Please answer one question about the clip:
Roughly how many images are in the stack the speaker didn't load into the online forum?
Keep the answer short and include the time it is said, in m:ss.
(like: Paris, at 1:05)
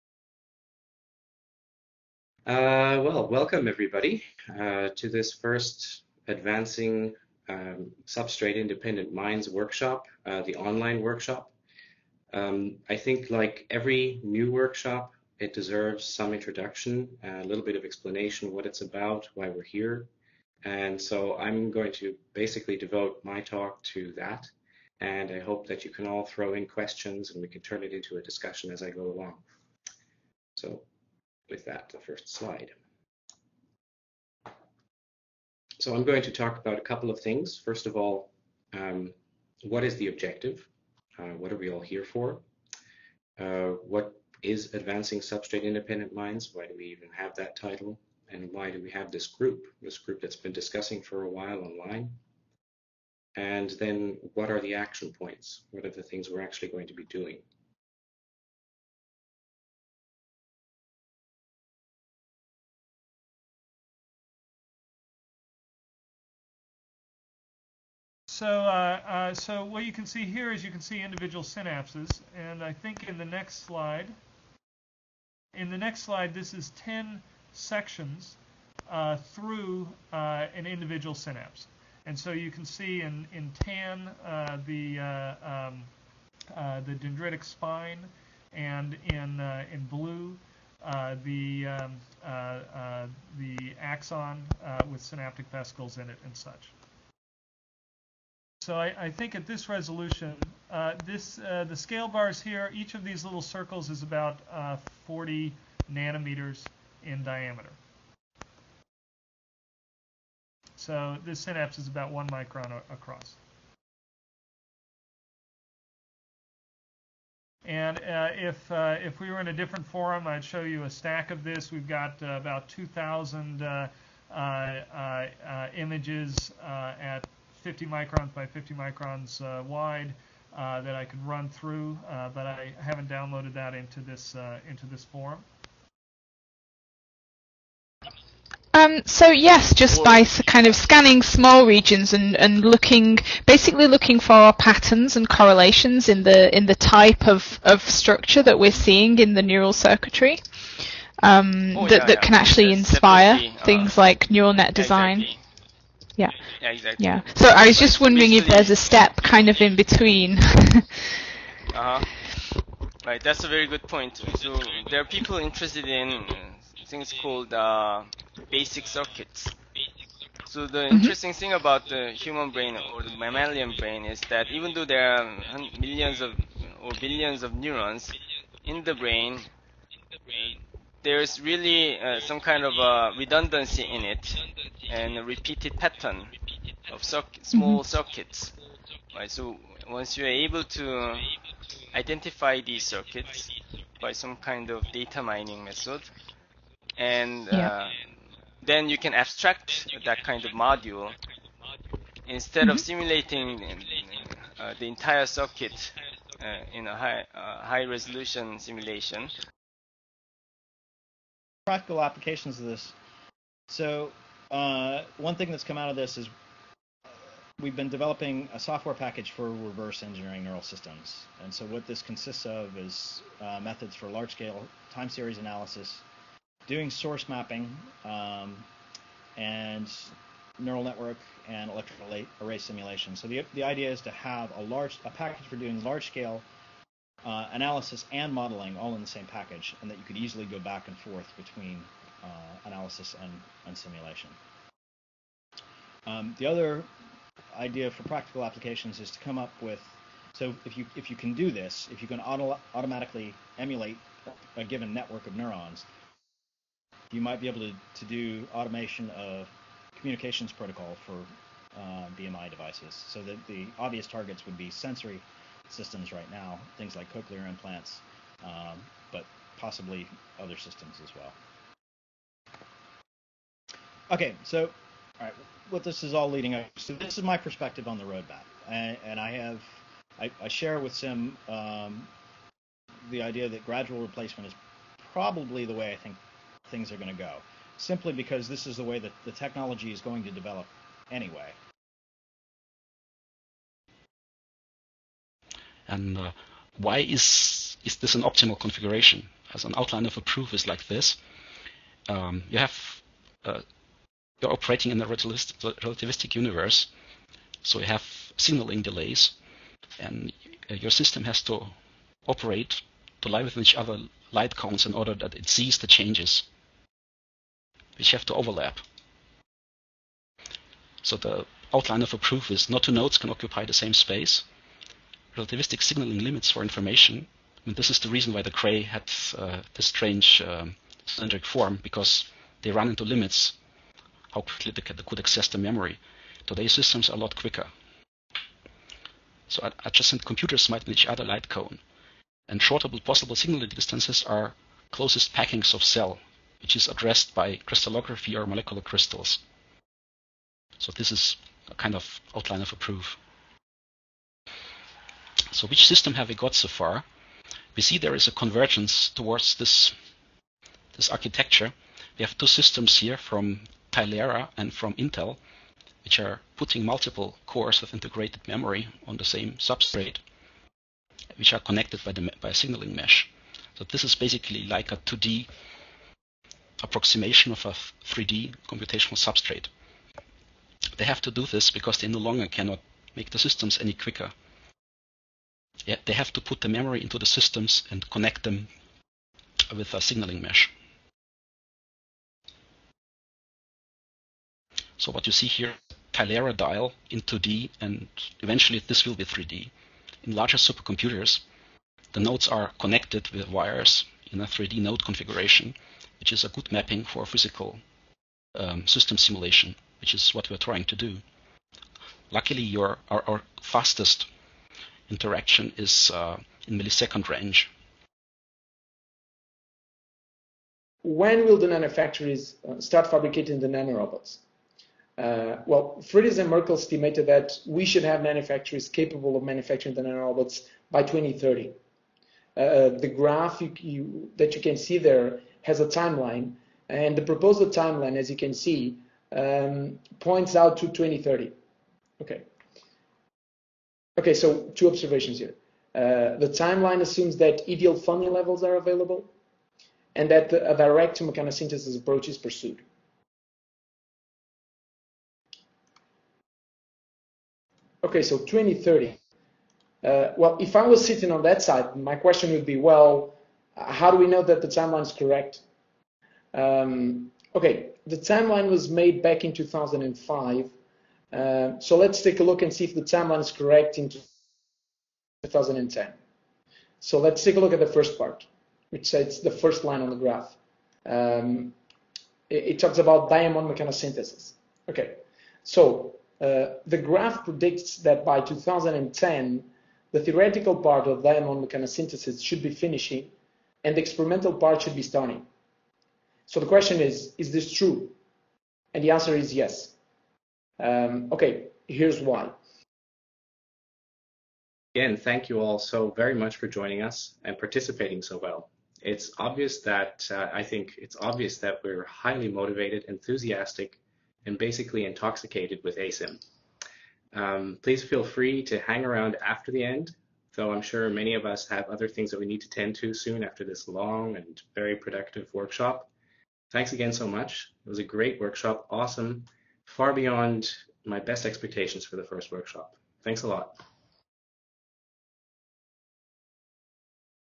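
2,000, at 2:02.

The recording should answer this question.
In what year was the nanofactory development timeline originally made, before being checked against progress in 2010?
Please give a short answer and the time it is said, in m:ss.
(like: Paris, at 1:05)
2005, at 7:49.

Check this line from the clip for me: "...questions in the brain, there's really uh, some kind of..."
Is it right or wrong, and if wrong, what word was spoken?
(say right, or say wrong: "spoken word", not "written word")
wrong: "neurons", not "questions".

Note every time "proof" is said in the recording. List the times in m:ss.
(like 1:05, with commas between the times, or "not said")
5:00, 5:22, 5:52.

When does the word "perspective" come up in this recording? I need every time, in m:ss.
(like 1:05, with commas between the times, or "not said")
4:37.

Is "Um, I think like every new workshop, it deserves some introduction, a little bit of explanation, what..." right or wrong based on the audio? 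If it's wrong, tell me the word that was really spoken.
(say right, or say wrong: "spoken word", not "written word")
right.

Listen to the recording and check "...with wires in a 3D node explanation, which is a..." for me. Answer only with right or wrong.
wrong.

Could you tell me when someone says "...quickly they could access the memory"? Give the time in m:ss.
5:34.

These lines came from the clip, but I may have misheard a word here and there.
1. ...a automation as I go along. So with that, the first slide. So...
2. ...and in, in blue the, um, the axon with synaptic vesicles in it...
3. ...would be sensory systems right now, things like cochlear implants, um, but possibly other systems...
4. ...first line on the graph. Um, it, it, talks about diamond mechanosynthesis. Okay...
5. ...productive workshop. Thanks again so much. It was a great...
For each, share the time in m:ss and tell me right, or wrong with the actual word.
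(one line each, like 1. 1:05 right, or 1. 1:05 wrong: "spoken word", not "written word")
1. 0:28 wrong: "discussion", not "automation"
2. 1:28 right
3. 4:24 right
4. 7:59 right
5. 8:44 right.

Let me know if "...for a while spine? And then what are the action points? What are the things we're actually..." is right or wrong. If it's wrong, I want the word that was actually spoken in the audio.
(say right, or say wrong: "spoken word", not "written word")
wrong: "online", not "spine".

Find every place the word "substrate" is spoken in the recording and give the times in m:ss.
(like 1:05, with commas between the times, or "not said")
0:08, 0:45, 6:09, 6:19.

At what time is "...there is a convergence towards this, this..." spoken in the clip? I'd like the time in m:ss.
5:57.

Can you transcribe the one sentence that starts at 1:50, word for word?
So this synapse is about one micron across.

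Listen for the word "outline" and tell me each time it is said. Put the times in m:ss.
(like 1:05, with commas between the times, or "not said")
4:59, 5:21, 5:52.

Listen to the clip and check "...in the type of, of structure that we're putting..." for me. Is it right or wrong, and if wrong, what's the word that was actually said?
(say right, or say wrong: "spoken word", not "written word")
wrong: "seeing", not "putting".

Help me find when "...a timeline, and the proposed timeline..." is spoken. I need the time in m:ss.
7:15.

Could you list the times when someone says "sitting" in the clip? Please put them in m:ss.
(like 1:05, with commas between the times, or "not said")
7:41.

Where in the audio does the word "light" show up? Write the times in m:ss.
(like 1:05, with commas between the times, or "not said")
5:14, 5:41.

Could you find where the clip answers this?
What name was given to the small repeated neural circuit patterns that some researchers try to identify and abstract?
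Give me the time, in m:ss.
2:48.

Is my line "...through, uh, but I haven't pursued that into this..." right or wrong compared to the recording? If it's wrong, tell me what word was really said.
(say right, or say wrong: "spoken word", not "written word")
wrong: "downloaded", not "pursued".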